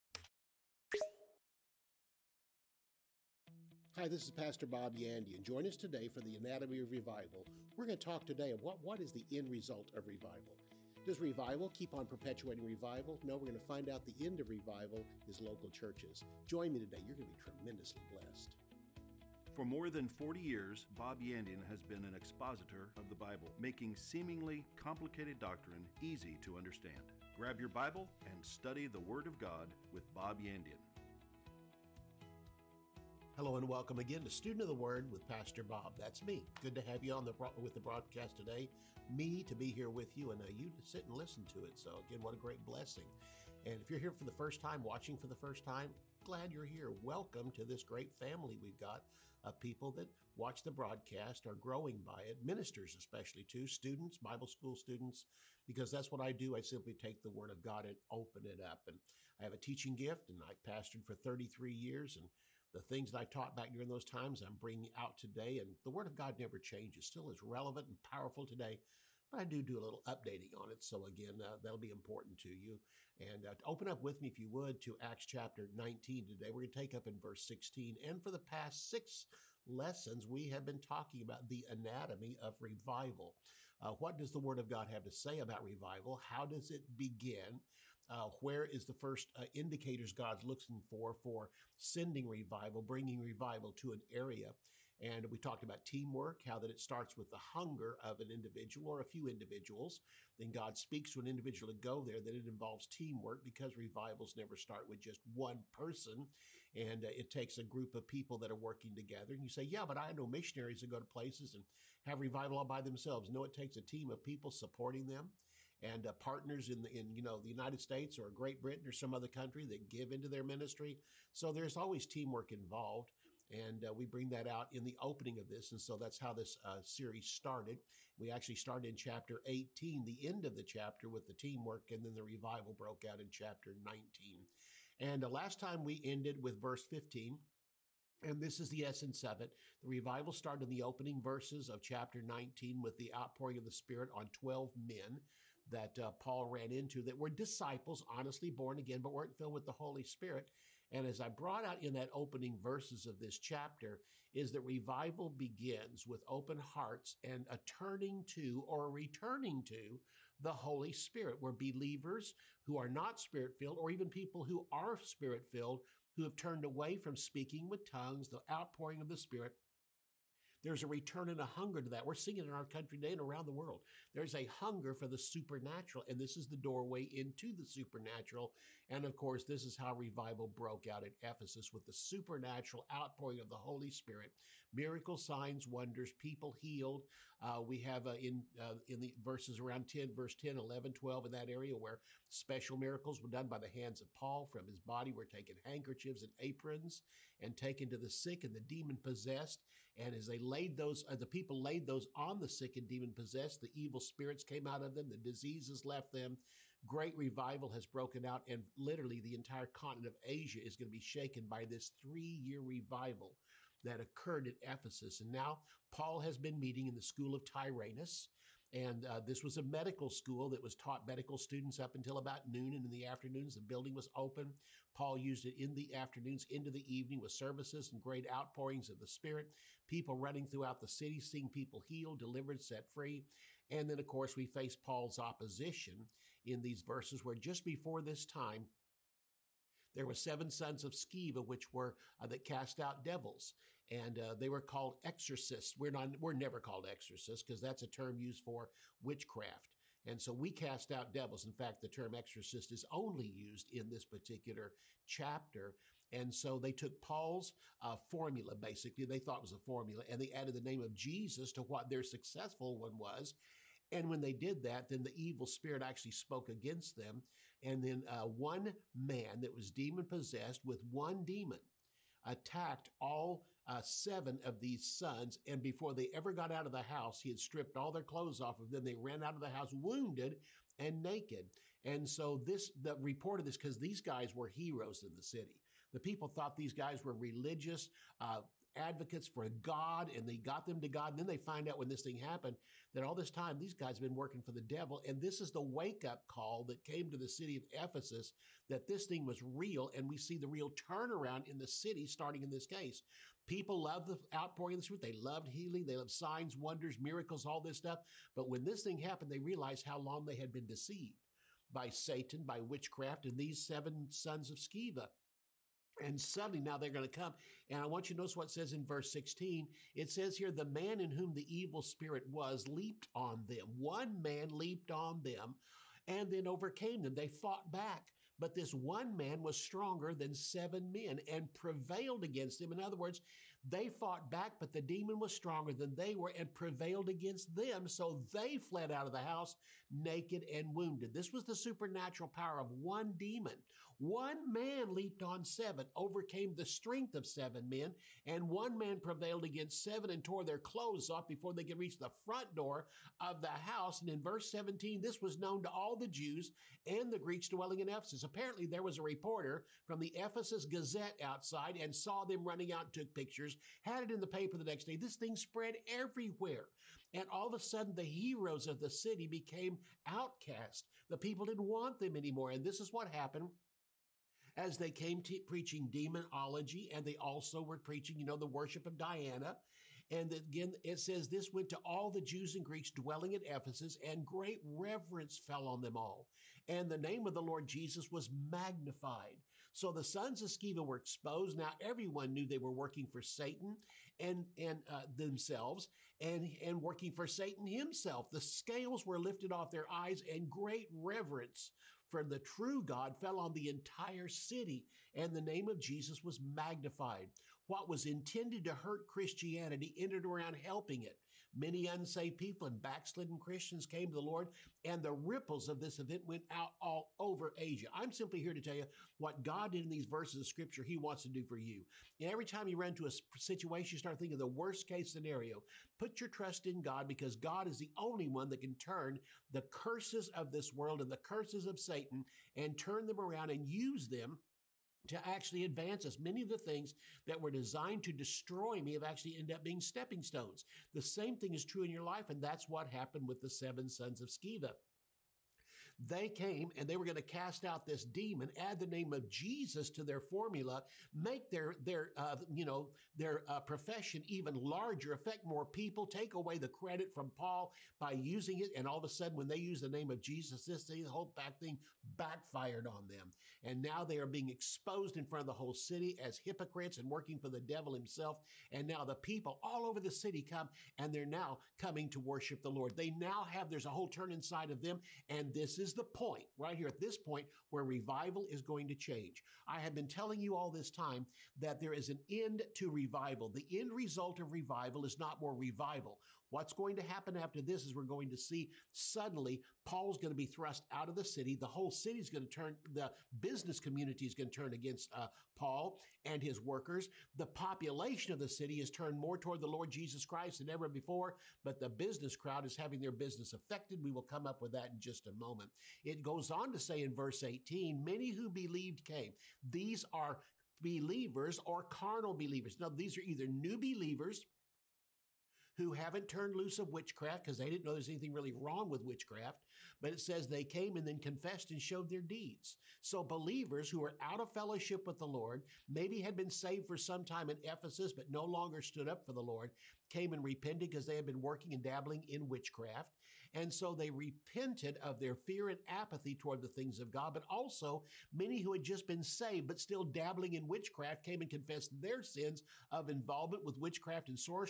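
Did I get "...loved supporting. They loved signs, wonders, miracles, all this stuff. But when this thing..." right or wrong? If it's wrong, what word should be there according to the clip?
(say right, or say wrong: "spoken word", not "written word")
wrong: "healing", not "supporting".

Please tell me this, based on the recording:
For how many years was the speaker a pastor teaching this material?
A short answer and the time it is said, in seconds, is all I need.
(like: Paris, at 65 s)
33, at 61 s.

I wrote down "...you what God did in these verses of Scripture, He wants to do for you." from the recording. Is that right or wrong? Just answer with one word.
right.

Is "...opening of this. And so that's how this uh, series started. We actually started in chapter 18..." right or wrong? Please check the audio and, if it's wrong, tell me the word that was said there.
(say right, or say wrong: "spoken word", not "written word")
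right.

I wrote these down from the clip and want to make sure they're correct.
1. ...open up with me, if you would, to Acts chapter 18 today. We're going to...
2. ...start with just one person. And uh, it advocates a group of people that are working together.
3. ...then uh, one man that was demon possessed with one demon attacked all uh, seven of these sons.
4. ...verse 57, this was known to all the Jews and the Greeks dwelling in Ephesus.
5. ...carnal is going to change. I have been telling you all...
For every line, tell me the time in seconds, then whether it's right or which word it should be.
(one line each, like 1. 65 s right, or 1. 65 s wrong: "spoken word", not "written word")
1. 73 s wrong: "19", not "18"
2. 104 s wrong: "takes", not "advocates"
3. 267 s right
4. 354 s wrong: "17", not "57"
5. 477 s wrong: "revival", not "carnal".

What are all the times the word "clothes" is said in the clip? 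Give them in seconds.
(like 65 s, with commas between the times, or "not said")
278 s, 350 s.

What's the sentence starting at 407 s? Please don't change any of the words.
What was intended to hurt Christianity ended around helping it.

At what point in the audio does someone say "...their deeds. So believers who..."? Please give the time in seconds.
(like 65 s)
522 s.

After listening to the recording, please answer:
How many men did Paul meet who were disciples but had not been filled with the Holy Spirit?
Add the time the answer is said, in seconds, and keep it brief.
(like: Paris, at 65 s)
12, at 144 s.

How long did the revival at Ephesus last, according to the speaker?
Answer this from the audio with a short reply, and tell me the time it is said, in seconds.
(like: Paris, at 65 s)
3 years, at 211 s.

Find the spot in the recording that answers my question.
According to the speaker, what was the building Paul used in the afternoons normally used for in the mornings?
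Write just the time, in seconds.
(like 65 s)
219 s.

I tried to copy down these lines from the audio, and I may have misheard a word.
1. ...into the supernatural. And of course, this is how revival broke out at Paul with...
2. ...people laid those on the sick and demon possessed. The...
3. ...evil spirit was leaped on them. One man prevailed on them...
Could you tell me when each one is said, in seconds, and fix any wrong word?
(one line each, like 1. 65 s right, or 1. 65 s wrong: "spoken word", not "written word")
1. 177 s wrong: "Ephesus", not "Paul"
2. 201 s right
3. 321 s wrong: "leaped", not "prevailed".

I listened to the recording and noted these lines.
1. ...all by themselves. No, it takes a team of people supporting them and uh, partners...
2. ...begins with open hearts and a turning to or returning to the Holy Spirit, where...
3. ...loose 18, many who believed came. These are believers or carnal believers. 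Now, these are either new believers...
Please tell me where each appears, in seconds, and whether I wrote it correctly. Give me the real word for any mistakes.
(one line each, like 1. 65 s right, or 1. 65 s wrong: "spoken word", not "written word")
1. 112 s right
2. 155 s right
3. 507 s wrong: "verse", not "loose".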